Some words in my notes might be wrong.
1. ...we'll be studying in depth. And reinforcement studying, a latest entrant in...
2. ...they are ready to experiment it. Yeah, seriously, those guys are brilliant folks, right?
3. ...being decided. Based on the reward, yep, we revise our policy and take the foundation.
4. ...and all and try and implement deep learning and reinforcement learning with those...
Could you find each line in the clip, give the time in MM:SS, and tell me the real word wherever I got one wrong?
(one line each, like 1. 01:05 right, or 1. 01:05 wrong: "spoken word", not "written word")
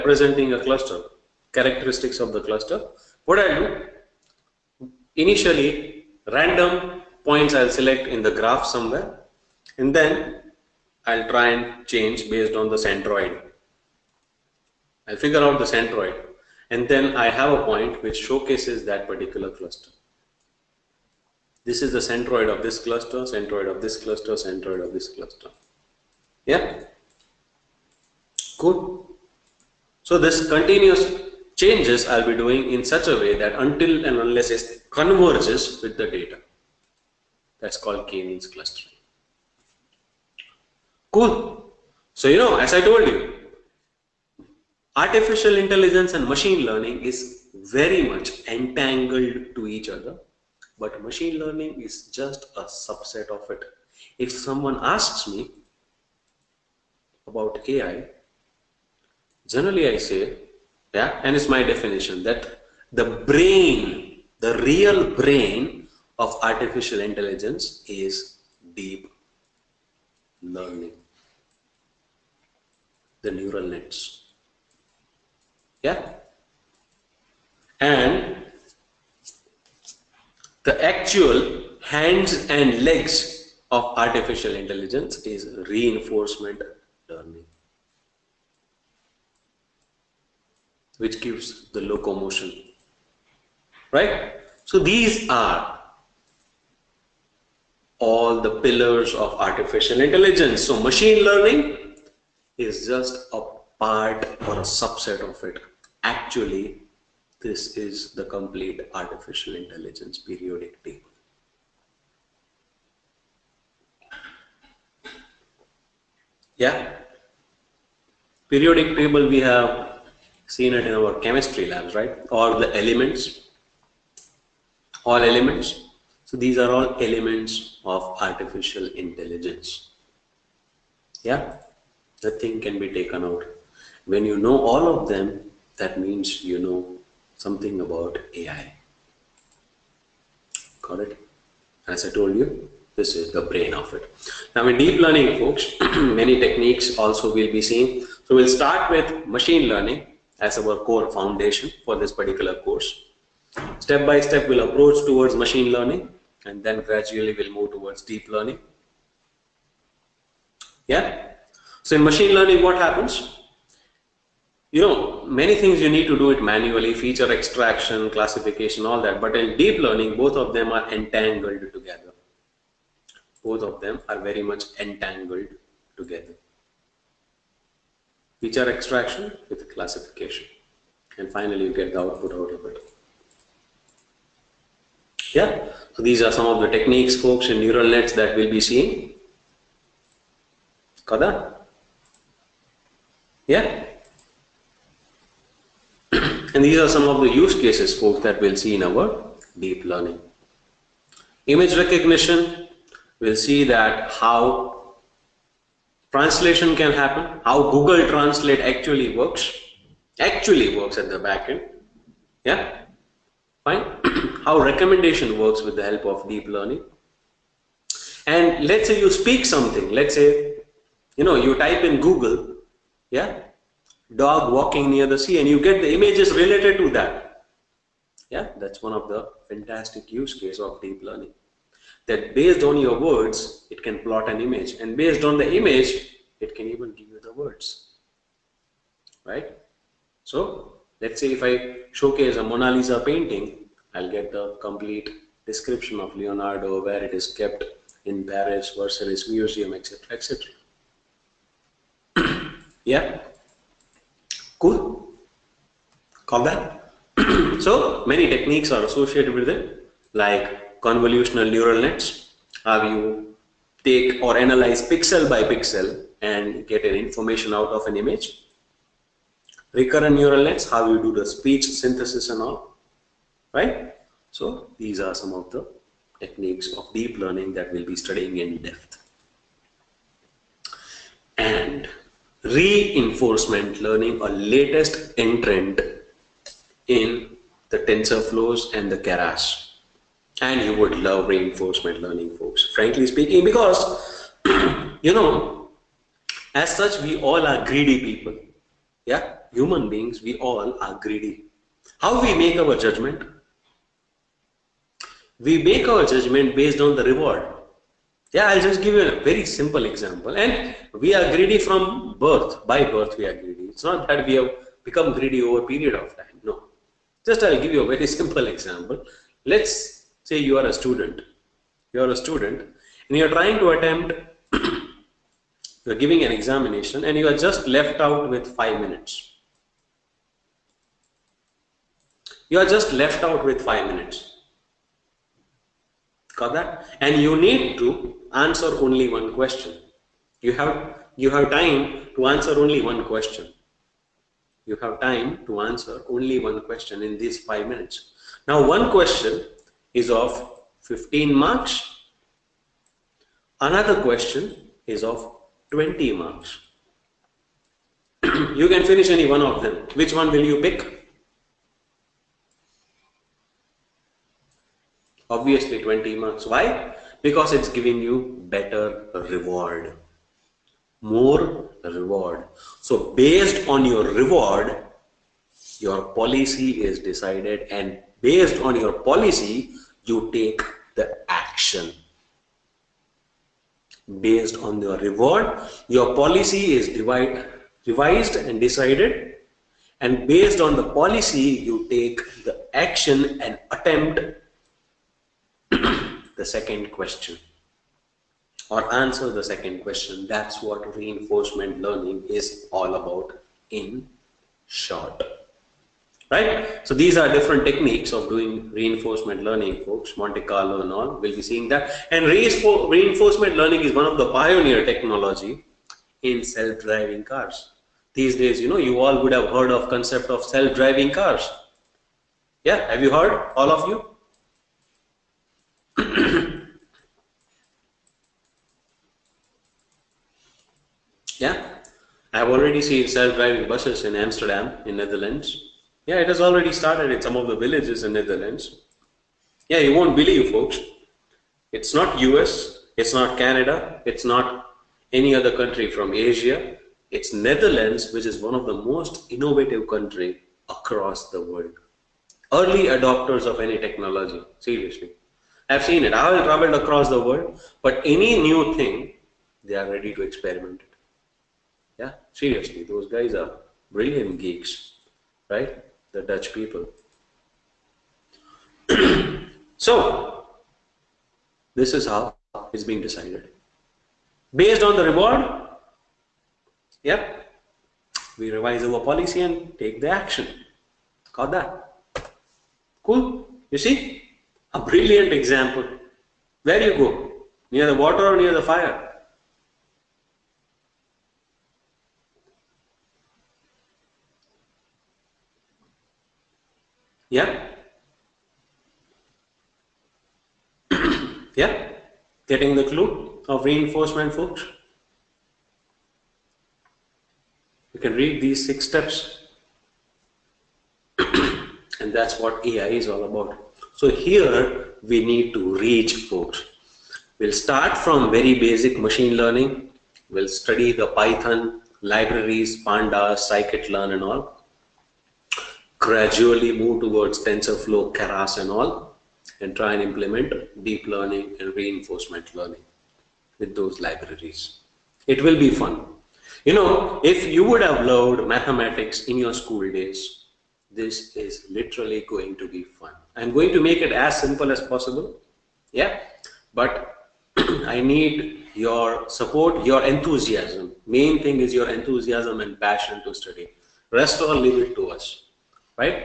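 1. 04:37 wrong: "learning", not "studying"
2. 07:39 wrong: "geeks", not "folks"
3. 07:52 wrong: "action", not "foundation"
4. 08:48 right.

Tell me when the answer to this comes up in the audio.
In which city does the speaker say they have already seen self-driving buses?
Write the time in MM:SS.
07:14.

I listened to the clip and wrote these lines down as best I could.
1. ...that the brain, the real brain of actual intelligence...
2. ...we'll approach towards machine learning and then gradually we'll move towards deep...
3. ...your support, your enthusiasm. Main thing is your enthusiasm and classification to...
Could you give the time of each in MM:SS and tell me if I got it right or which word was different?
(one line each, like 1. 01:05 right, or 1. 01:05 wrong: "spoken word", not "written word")
1. 01:02 wrong: "artificial", not "actual"
2. 02:34 right
3. 09:08 wrong: "passion", not "classification".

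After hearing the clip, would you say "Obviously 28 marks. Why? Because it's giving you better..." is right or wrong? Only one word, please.
wrong.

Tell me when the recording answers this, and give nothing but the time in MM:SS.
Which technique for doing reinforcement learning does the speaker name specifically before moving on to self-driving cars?
06:50.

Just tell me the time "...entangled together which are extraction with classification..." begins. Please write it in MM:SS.
02:54.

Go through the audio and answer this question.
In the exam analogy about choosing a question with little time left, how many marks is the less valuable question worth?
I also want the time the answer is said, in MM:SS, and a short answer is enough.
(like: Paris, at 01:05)
15, at 05:50.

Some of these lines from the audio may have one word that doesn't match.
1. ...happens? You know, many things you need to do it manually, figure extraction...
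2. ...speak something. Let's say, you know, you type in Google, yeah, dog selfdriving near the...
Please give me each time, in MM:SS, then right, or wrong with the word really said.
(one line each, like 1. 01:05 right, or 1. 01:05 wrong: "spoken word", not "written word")
1. 02:42 wrong: "feature", not "figure"
2. 03:39 wrong: "walking", not "selfdriving".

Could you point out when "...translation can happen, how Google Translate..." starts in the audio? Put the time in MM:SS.
03:26.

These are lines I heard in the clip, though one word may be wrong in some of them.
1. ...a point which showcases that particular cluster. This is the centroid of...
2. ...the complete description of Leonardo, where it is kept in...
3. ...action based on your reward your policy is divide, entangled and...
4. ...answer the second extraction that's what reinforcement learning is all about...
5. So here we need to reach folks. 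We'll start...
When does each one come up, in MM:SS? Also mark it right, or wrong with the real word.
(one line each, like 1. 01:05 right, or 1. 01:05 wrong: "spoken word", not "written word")
1. 00:17 right
2. 04:04 right
3. 06:21 wrong: "revised", not "entangled"
4. 06:38 wrong: "question", not "extraction"
5. 08:33 right.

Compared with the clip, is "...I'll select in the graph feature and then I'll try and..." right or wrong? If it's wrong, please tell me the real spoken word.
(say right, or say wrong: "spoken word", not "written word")
wrong: "somewhere", not "feature".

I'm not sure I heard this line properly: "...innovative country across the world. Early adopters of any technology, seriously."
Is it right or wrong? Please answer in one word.
right.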